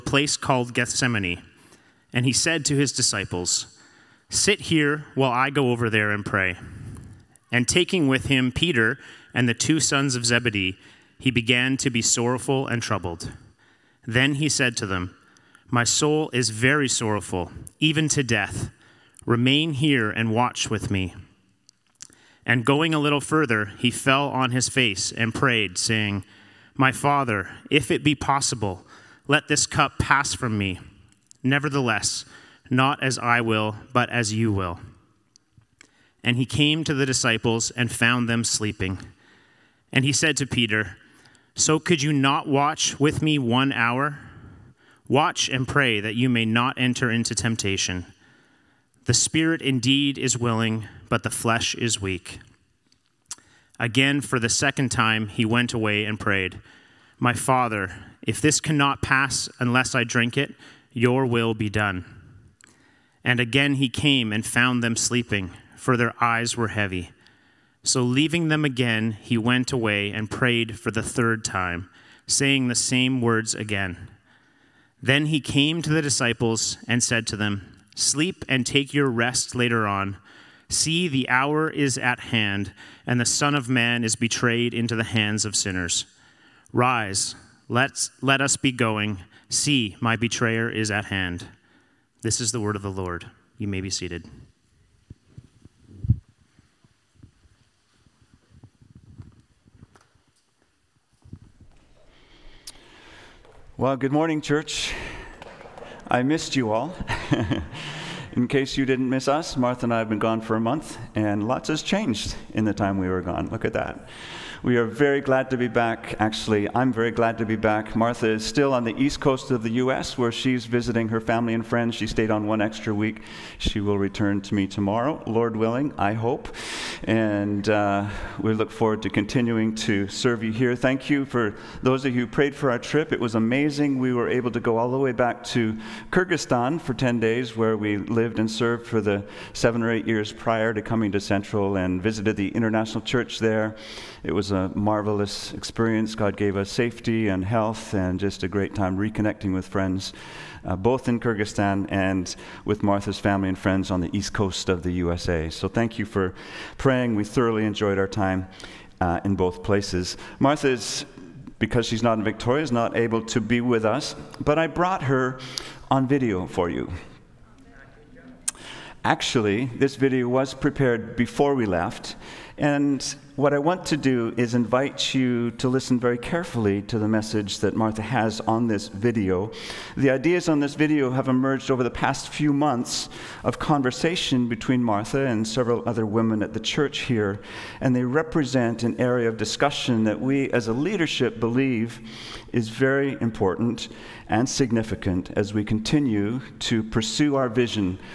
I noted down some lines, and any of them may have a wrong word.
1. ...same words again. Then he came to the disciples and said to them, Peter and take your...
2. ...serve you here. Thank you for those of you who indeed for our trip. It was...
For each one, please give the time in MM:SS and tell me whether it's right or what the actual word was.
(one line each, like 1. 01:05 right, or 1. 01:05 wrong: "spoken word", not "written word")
1. 01:12 wrong: "Sleep", not "Peter"
2. 02:10 wrong: "prayed", not "indeed".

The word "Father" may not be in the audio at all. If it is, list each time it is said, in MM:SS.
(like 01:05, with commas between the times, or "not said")
00:26, 00:57.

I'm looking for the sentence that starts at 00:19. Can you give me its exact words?
Remain here and watch with me.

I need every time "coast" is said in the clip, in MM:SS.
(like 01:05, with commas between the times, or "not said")
01:59, 02:34.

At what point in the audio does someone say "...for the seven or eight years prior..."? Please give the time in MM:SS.
02:18.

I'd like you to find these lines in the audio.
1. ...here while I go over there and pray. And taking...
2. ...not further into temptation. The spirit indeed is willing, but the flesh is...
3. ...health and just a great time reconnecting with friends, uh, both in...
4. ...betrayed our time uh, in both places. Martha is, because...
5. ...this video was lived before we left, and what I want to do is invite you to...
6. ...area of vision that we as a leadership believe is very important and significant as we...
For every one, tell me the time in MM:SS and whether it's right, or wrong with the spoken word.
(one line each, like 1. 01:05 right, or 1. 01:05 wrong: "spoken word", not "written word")
1. 00:04 right
2. 00:46 wrong: "enter", not "further"
3. 02:27 right
4. 02:37 wrong: "enjoyed", not "betrayed"
5. 02:49 wrong: "prepared", not "lived"
6. 03:08 wrong: "discussion", not "vision".